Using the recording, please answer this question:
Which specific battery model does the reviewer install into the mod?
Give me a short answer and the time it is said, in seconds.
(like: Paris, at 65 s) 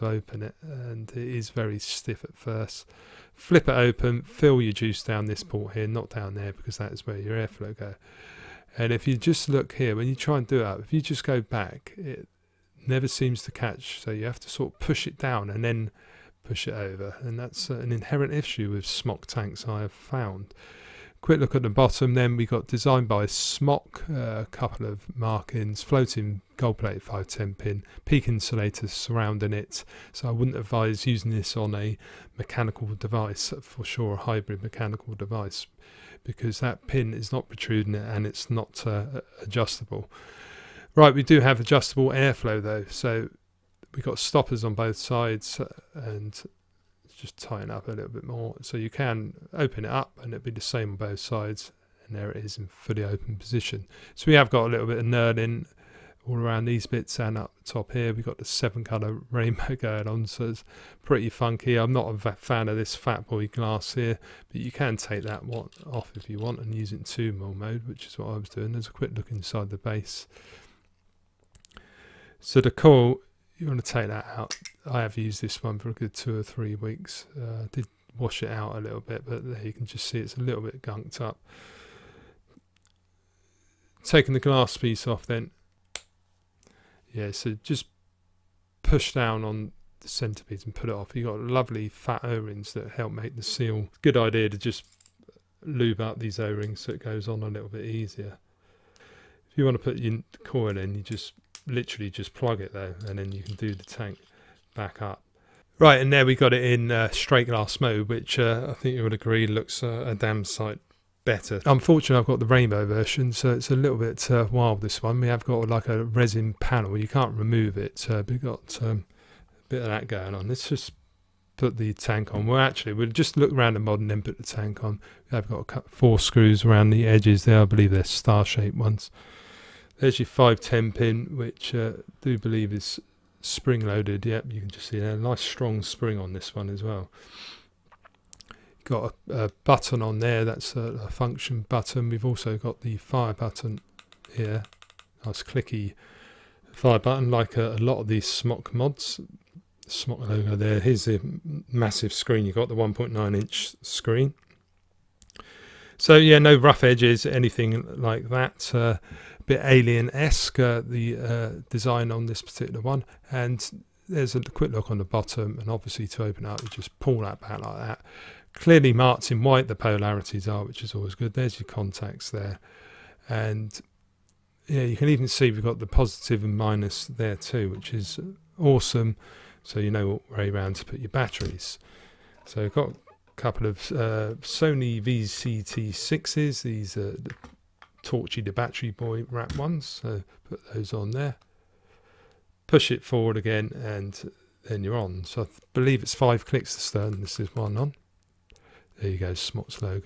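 Sony VTC6, at 184 s.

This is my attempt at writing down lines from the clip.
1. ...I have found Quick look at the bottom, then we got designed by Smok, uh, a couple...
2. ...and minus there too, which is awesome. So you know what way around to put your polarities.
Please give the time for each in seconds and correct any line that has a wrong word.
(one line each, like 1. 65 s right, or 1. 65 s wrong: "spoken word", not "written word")
1. 19 s right
2. 176 s wrong: "batteries", not "polarities".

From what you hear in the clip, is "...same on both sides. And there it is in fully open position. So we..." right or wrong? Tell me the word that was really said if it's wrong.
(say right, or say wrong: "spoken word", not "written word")
right.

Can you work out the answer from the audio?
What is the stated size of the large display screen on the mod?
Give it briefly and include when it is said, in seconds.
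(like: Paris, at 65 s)
1.9 inch, at 152 s.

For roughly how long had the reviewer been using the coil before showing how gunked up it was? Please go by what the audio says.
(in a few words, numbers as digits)
2 or 3 weeks.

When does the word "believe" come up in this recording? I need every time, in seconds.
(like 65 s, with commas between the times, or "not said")
127 s, 132 s, 195 s.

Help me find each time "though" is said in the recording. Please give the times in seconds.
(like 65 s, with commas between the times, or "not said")
42 s, 102 s.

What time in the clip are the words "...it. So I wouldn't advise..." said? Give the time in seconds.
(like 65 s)
29 s.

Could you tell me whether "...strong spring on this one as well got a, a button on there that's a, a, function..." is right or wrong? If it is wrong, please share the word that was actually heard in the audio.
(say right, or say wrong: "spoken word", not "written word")
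right.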